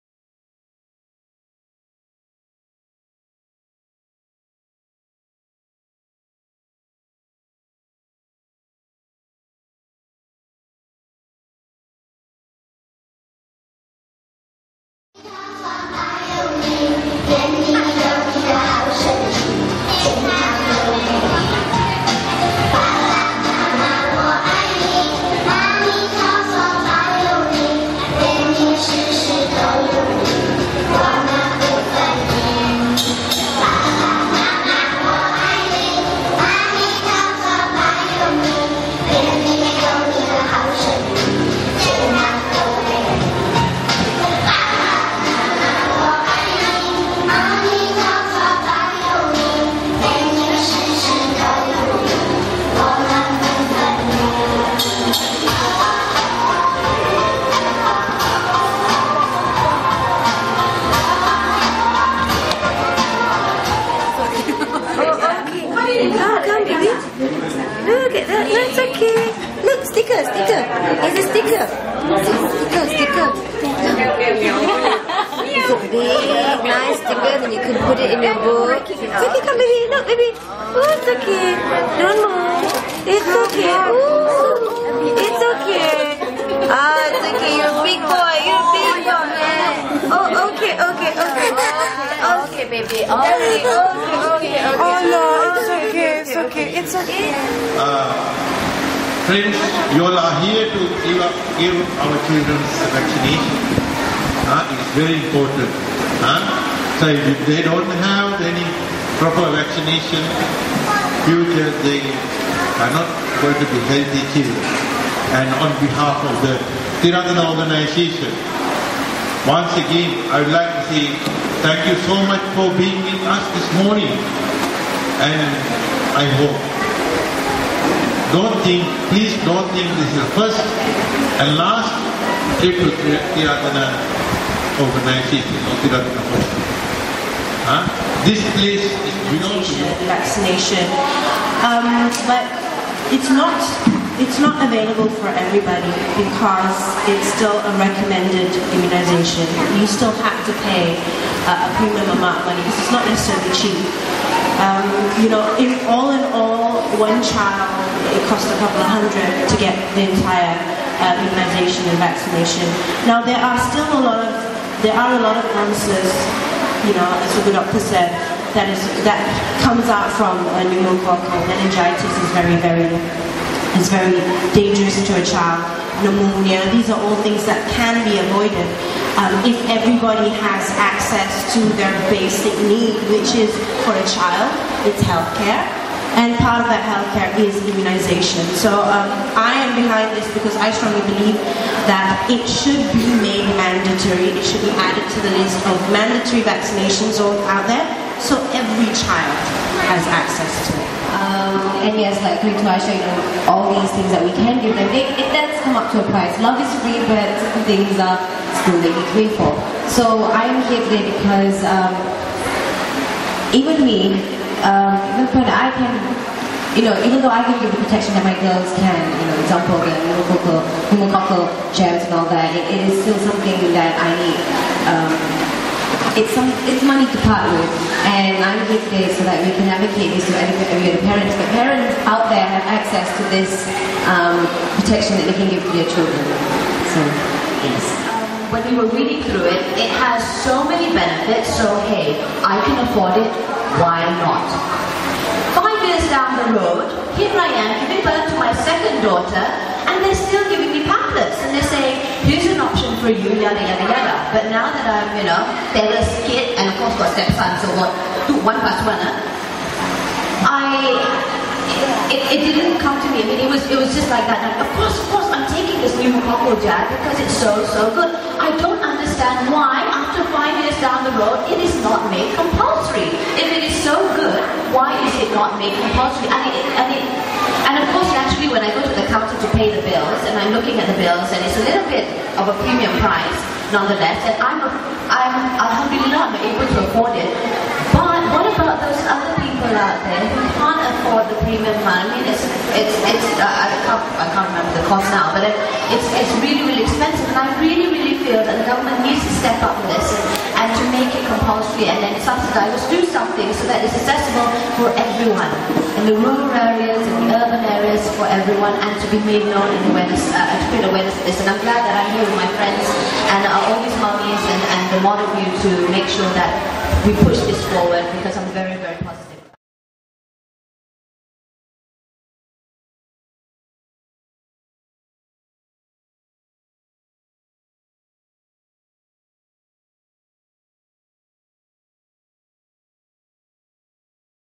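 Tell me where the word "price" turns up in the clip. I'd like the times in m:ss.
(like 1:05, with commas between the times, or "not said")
3:26, 4:43.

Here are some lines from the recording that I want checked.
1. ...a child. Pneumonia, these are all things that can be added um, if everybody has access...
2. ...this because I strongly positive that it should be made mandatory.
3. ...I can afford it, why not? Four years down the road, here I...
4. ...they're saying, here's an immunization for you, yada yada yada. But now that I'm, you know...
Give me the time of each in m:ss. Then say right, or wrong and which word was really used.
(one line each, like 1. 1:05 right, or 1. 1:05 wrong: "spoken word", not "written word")
1. 2:55 wrong: "avoided", not "added"
2. 3:10 wrong: "believe", not "positive"
3. 4:02 wrong: "Five", not "Four"
4. 4:11 wrong: "option", not "immunization".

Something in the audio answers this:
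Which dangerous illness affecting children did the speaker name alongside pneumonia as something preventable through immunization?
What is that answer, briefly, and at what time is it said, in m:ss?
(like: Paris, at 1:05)
pneumococcal meningitis, at 2:50.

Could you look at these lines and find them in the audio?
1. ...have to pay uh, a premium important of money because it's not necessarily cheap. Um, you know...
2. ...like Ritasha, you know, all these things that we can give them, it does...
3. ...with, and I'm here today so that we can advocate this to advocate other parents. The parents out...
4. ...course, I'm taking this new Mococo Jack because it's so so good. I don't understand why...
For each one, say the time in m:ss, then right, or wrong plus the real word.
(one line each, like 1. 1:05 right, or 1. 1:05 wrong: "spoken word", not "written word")
1. 2:30 wrong: "amount", not "important"
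2. 3:22 right
3. 3:47 wrong: "educate", not "advocate"
4. 4:25 right.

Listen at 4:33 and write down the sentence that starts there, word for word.
If it is so good, why is it not made compulsory?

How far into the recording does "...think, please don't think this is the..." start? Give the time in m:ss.
2:08.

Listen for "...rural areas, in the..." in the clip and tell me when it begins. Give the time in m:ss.
5:06.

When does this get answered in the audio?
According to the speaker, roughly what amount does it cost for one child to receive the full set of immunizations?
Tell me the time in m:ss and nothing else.
2:38.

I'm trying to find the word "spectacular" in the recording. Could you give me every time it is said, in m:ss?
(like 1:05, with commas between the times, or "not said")
not said.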